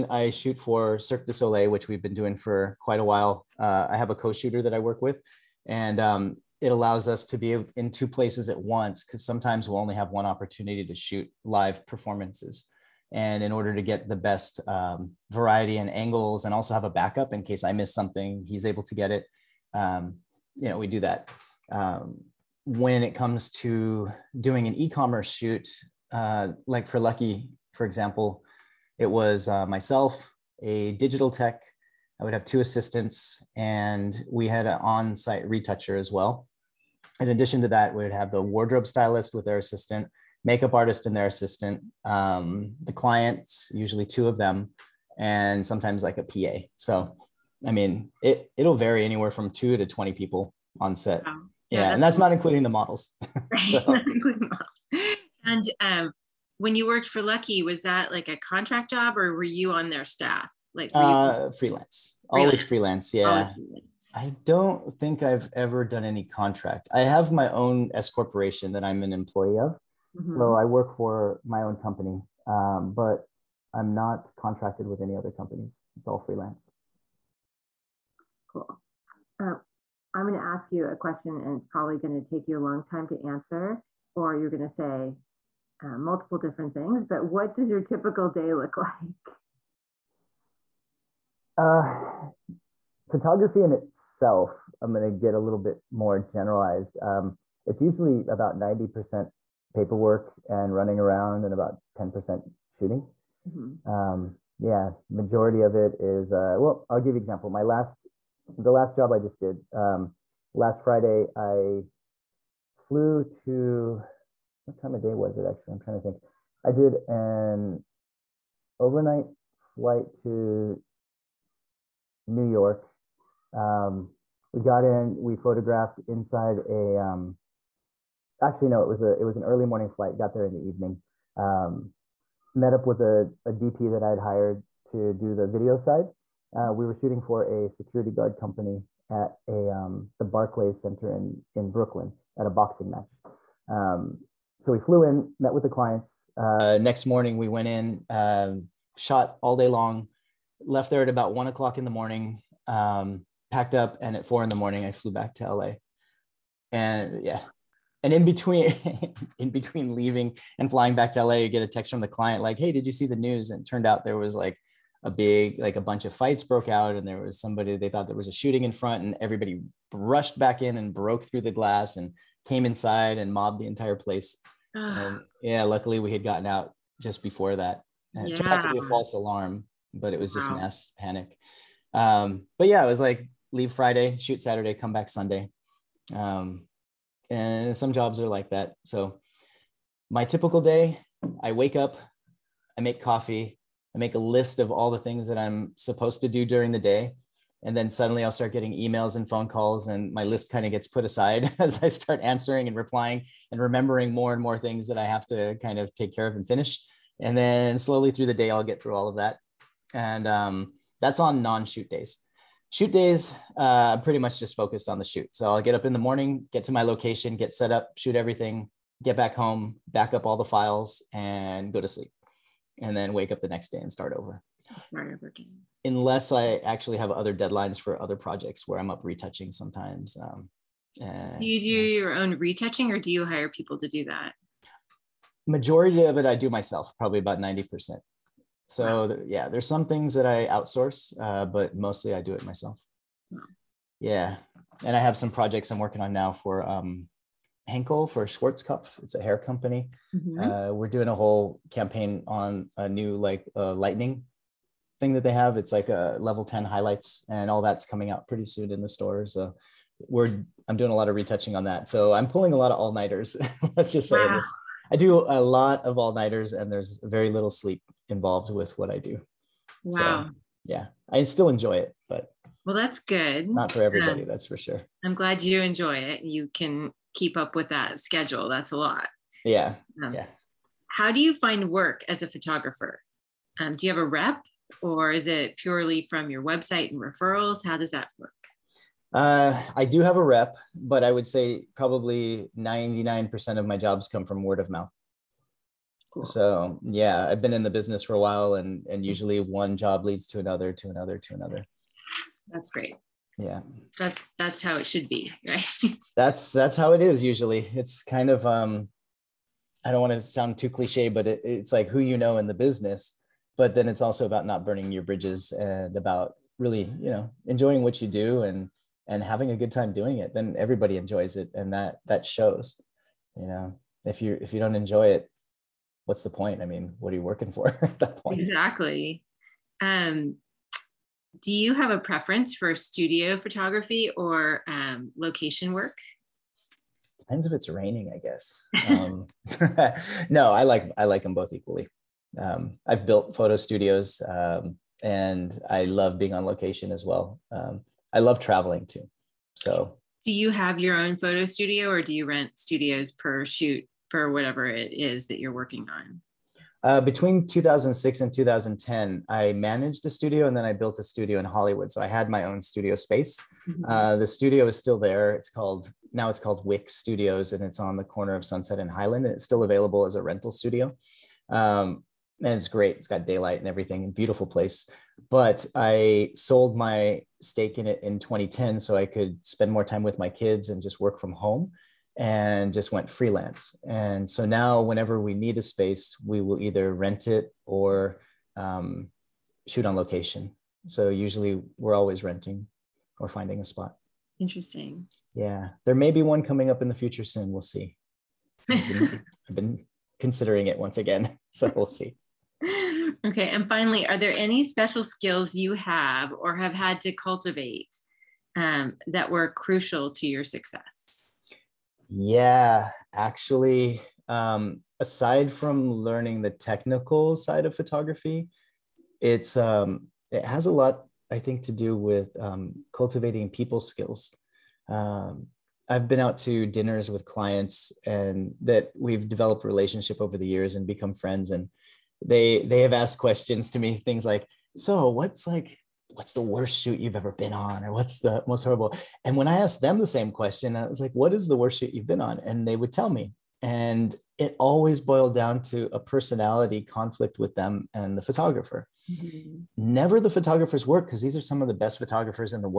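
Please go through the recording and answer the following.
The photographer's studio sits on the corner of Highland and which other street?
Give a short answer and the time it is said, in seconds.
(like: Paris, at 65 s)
Sunset, at 368 s.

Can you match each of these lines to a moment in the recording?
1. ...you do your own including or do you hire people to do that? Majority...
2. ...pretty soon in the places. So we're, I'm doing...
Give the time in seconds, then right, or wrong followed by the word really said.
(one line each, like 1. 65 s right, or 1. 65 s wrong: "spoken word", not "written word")
1. 231 s wrong: "retouching", not "including"
2. 258 s wrong: "stores", not "places".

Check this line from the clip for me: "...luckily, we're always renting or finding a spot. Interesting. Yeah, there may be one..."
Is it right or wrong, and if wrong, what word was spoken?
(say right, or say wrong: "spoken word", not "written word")
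wrong: "usually", not "luckily".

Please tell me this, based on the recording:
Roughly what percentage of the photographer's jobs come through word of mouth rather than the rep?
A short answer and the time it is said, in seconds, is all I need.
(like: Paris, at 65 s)
99%, at 292 s.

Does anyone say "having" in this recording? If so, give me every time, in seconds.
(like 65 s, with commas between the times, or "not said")
319 s.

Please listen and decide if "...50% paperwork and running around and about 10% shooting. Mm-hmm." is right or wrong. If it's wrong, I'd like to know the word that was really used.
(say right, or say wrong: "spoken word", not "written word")
wrong: "90", not "50".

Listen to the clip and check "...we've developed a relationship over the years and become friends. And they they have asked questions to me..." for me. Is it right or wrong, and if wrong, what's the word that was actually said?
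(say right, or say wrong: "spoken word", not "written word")
right.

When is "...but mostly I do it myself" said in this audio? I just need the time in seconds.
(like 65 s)
241 s.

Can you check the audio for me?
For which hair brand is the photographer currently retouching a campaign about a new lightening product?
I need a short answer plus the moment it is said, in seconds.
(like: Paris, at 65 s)
Schwarzkopf, at 248 s.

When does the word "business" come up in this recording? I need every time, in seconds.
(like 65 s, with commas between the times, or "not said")
297 s, 312 s.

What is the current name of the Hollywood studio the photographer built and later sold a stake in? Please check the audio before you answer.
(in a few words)
Wick Studios.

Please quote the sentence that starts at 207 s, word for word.
And then slowly through the day, I'll get through all of that.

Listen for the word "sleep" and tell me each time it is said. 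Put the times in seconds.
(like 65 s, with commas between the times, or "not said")
221 s, 267 s.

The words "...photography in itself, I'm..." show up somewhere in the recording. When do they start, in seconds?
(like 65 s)
93 s.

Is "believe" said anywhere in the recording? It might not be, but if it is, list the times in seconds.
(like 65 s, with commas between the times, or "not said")
not said.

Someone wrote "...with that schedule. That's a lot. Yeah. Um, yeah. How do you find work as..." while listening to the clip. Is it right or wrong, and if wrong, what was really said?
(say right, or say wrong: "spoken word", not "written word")
right.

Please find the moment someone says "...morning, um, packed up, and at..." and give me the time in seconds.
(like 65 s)
151 s.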